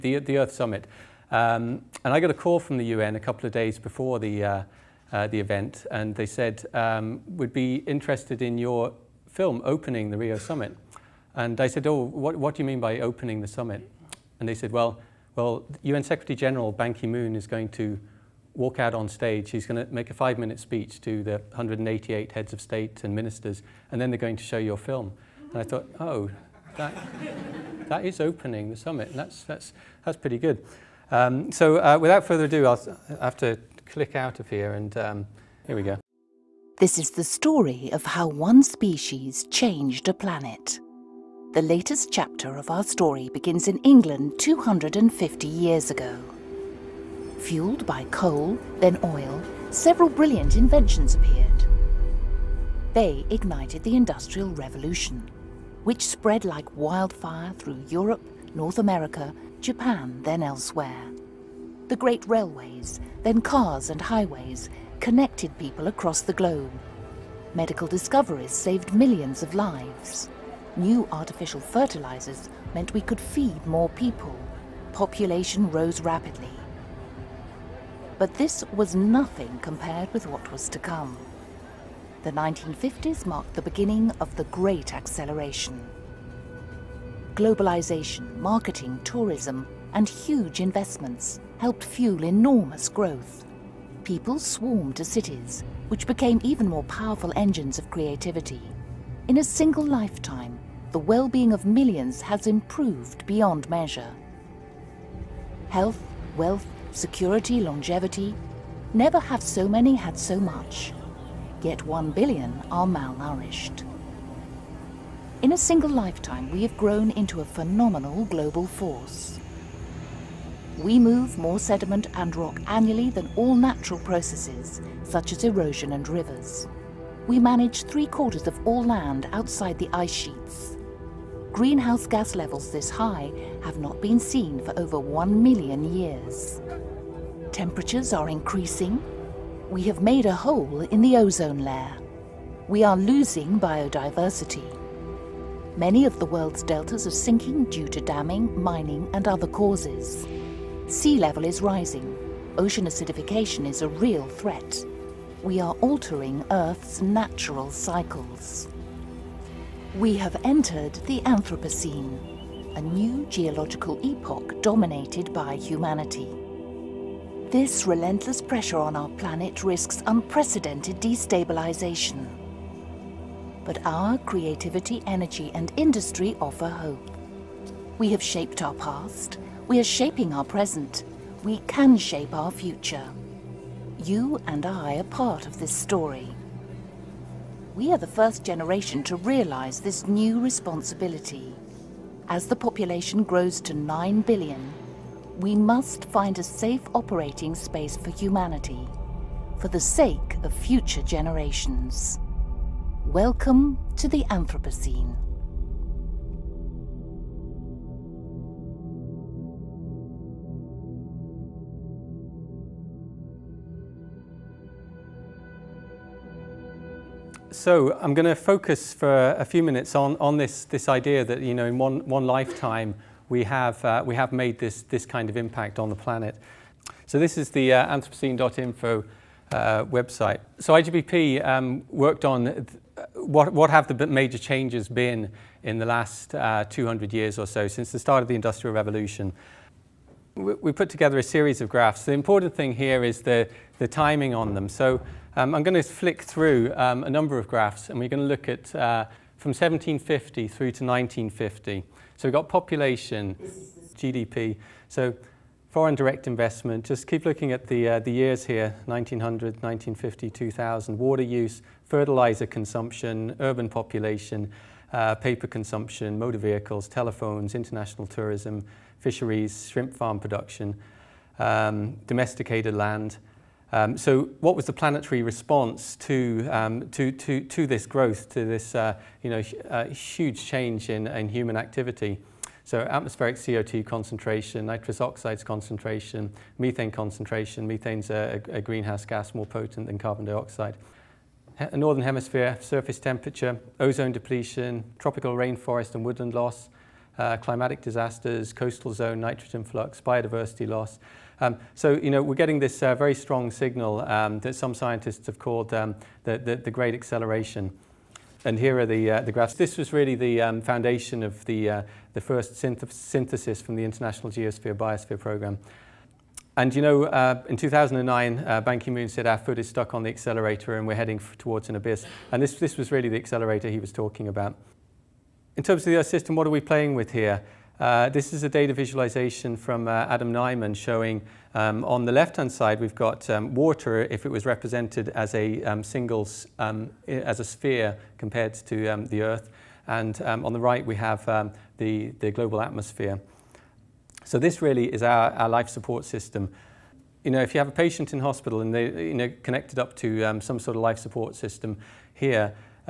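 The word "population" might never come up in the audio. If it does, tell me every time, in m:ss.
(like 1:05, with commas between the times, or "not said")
1:14, 3:12, 4:12, 4:23.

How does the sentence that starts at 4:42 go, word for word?
So atmospheric CO2 concentration, nitrous oxides concentration, methane concentration.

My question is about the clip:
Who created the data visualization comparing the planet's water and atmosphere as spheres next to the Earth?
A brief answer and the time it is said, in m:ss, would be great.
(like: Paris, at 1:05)
Adam Nieman, at 5:30.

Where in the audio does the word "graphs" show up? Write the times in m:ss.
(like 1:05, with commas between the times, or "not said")
4:01, 4:07, 5:09.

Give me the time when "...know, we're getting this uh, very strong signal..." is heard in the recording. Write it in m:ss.
5:02.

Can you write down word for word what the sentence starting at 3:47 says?
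So this is the uh, Anthropocene.info uh, website.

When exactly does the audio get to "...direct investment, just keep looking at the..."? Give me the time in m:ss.
4:15.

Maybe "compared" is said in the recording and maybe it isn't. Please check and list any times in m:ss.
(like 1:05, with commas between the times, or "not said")
1:19, 5:38.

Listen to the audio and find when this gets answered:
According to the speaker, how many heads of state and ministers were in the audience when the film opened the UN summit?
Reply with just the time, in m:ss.
0:21.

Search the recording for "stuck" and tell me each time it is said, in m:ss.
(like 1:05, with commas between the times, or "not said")
5:19.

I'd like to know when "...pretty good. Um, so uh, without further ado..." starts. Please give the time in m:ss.
0:30.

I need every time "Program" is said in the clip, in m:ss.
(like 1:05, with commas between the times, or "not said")
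5:15.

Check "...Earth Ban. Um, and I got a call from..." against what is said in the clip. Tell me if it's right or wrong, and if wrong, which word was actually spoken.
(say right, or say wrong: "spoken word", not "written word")
wrong: "Summit", not "Ban".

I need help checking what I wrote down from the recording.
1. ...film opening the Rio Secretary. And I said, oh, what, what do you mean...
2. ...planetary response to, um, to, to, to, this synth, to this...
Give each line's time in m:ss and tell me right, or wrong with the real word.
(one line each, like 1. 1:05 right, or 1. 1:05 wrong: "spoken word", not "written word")
1. 0:09 wrong: "Summit", not "Secretary"
2. 4:34 wrong: "growth", not "synth".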